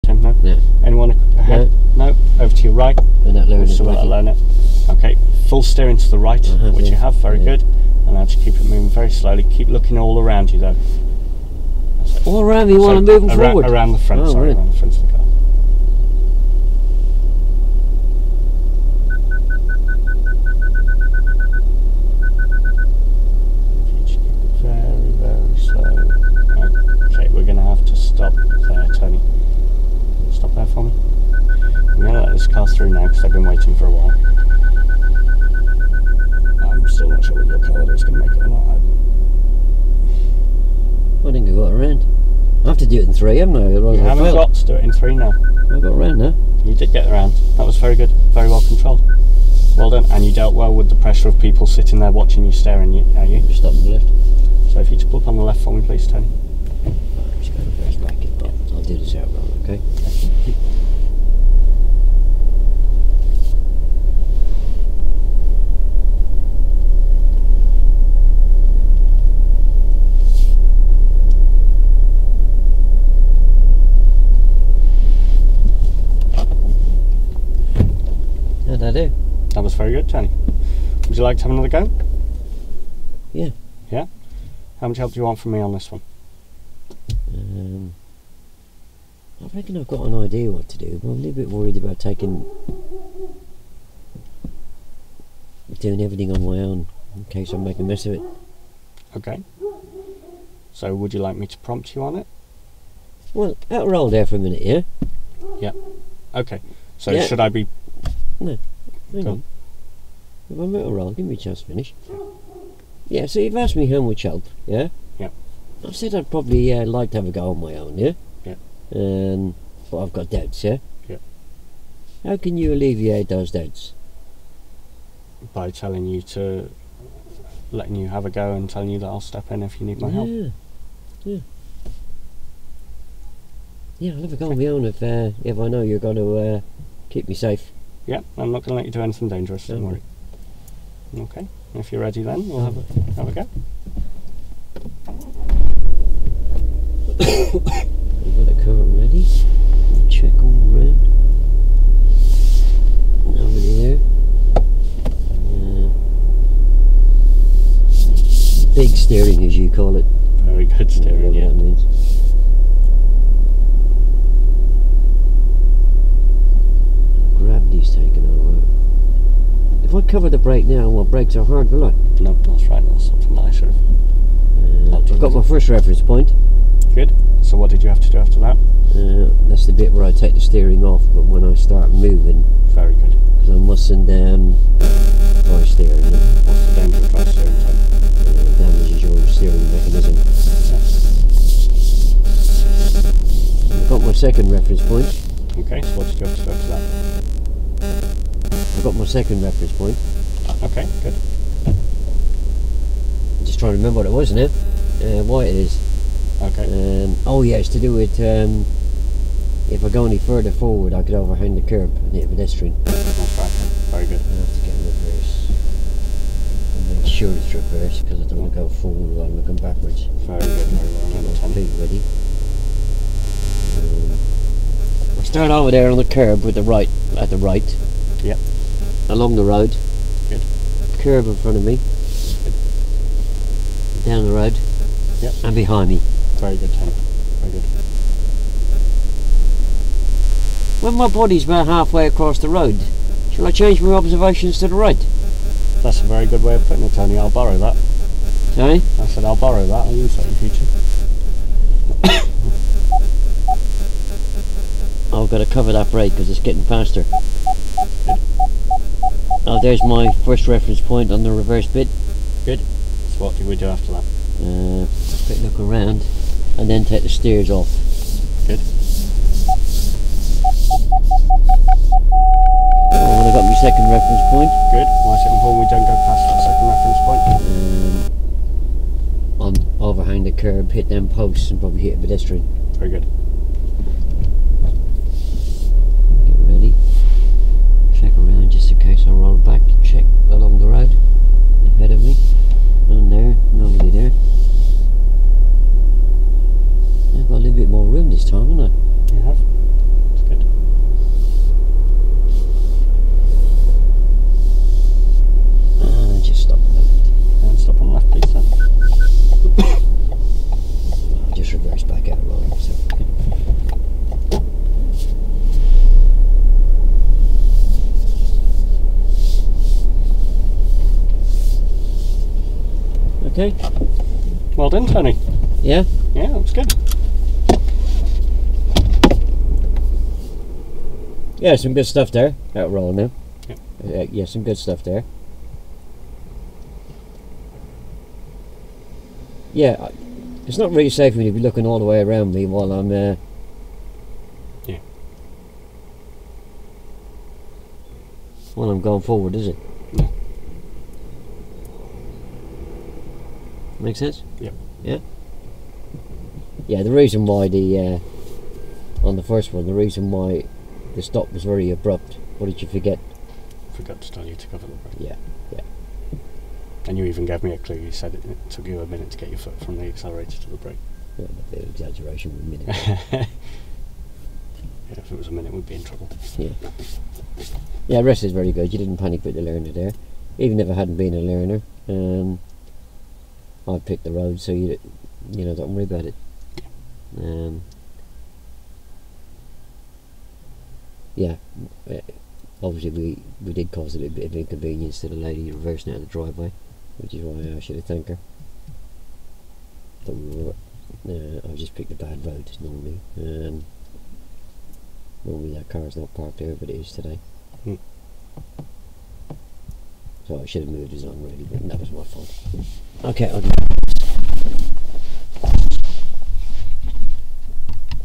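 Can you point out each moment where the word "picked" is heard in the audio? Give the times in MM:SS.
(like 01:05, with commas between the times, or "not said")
06:23, 06:41.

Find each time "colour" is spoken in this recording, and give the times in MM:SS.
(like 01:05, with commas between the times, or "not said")
00:37.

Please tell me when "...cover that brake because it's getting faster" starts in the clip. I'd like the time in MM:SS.
04:15.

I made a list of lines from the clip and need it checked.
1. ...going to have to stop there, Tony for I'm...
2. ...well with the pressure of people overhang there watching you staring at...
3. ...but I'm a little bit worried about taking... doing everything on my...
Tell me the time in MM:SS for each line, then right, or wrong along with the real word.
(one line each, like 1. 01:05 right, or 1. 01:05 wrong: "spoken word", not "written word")
1. 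00:27 right
2. 00:50 wrong: "sitting", not "overhang"
3. 01:31 right.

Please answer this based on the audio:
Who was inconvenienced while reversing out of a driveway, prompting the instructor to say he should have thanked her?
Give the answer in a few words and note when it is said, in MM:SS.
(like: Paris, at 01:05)
the lady, at 06:35.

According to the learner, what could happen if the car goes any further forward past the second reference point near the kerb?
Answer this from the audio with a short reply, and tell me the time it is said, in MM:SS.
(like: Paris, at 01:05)
hit a pedestrian, at 03:32.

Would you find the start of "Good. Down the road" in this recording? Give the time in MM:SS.
03:52.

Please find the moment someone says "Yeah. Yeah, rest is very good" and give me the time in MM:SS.
06:16.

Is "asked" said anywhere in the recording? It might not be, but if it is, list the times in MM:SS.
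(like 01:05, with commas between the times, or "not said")
01:53.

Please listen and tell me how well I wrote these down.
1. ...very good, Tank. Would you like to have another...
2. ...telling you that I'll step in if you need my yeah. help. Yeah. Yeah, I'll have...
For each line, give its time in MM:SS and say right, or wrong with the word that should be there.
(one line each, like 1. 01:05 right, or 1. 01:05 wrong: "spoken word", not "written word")
1. 01:19 wrong: "Tony", not "Tank"
2. 02:08 right.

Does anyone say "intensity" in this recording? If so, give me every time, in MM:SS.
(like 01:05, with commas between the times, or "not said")
not said.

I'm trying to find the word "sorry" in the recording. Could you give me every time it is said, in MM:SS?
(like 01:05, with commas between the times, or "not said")
00:14, 04:08.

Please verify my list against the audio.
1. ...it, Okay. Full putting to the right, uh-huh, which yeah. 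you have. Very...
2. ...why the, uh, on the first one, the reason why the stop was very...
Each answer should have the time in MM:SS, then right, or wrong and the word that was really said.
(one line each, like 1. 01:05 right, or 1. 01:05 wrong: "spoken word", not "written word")
1. 00:04 wrong: "steering", not "putting"
2. 05:57 right.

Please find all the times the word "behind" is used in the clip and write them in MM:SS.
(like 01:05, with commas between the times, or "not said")
03:55.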